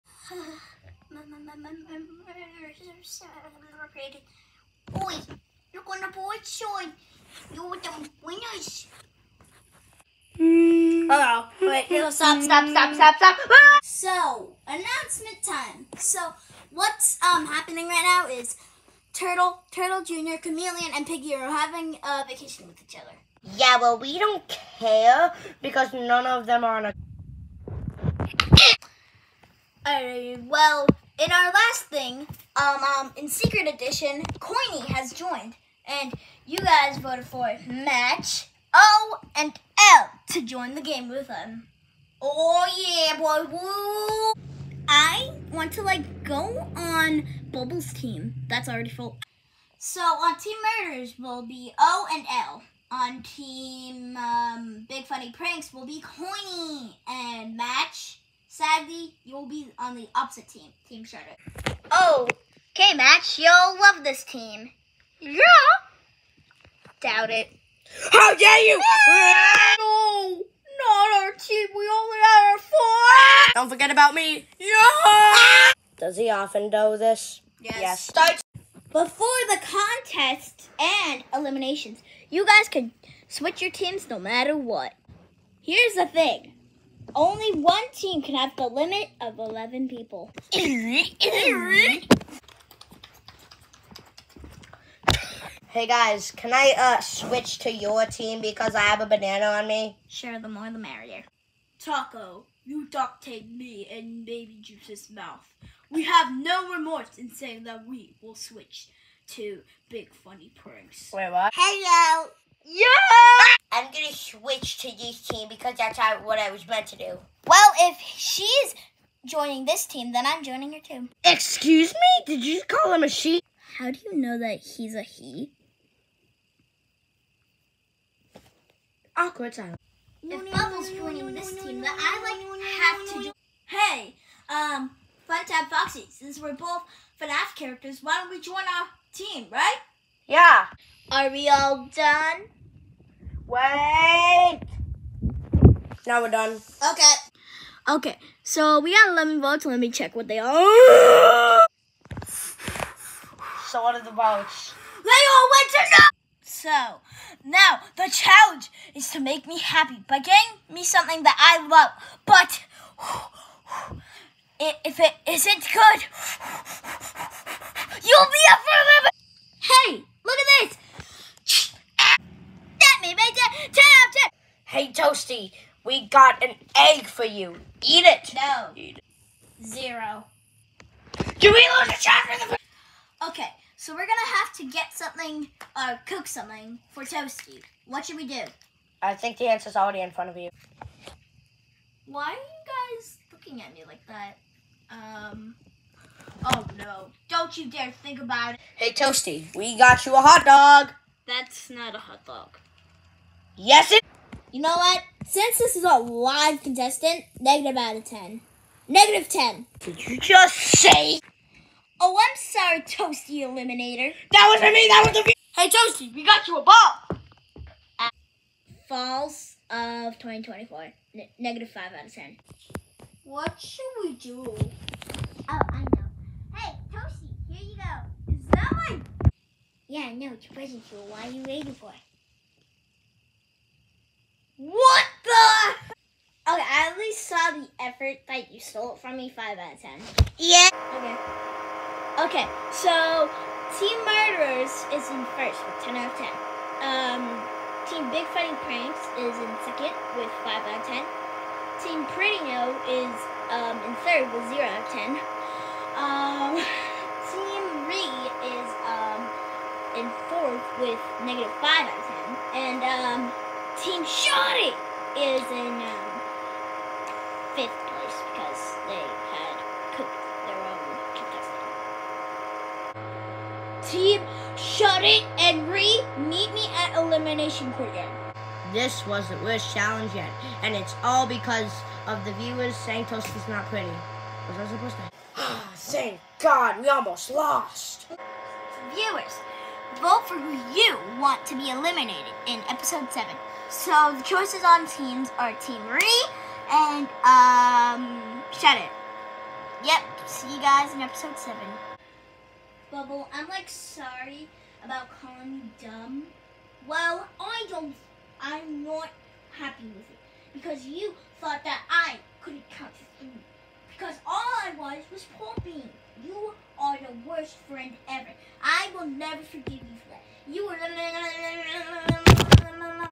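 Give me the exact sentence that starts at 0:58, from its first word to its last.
Sadly, you'll be on the opposite team, Team Shredder.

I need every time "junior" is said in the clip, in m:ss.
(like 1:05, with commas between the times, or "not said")
not said.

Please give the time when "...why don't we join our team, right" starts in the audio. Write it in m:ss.
2:18.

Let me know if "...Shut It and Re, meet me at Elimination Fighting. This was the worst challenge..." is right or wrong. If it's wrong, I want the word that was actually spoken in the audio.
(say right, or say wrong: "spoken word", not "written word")
wrong: "Corner", not "Fighting".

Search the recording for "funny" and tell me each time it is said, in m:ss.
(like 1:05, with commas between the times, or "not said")
0:55, 1:50.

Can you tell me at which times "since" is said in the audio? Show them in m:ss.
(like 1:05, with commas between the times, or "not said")
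2:16, 3:25.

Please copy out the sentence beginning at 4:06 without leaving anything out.
Um, Team Big Fighting Pranks is in second with 5 out of 10.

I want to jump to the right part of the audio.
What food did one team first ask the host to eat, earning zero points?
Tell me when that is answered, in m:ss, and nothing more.
2:56.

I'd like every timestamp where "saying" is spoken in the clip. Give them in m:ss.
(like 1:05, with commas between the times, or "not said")
1:47, 4:42.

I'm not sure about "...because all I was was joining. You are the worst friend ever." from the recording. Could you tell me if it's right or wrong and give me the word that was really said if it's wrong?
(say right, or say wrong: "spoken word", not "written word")
wrong: "pooping", not "joining".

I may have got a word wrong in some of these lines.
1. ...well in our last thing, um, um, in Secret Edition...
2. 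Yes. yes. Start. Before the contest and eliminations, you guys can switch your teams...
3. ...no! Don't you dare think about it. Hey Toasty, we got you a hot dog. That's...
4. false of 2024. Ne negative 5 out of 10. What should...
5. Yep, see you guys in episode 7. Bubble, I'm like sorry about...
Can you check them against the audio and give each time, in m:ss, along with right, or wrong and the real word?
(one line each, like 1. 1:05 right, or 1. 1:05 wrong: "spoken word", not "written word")
1. 0:30 right
2. 1:17 right
3. 3:16 right
4. 3:38 right
5. 4:59 right.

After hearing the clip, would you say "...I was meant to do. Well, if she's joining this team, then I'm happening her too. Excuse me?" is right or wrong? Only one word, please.
wrong.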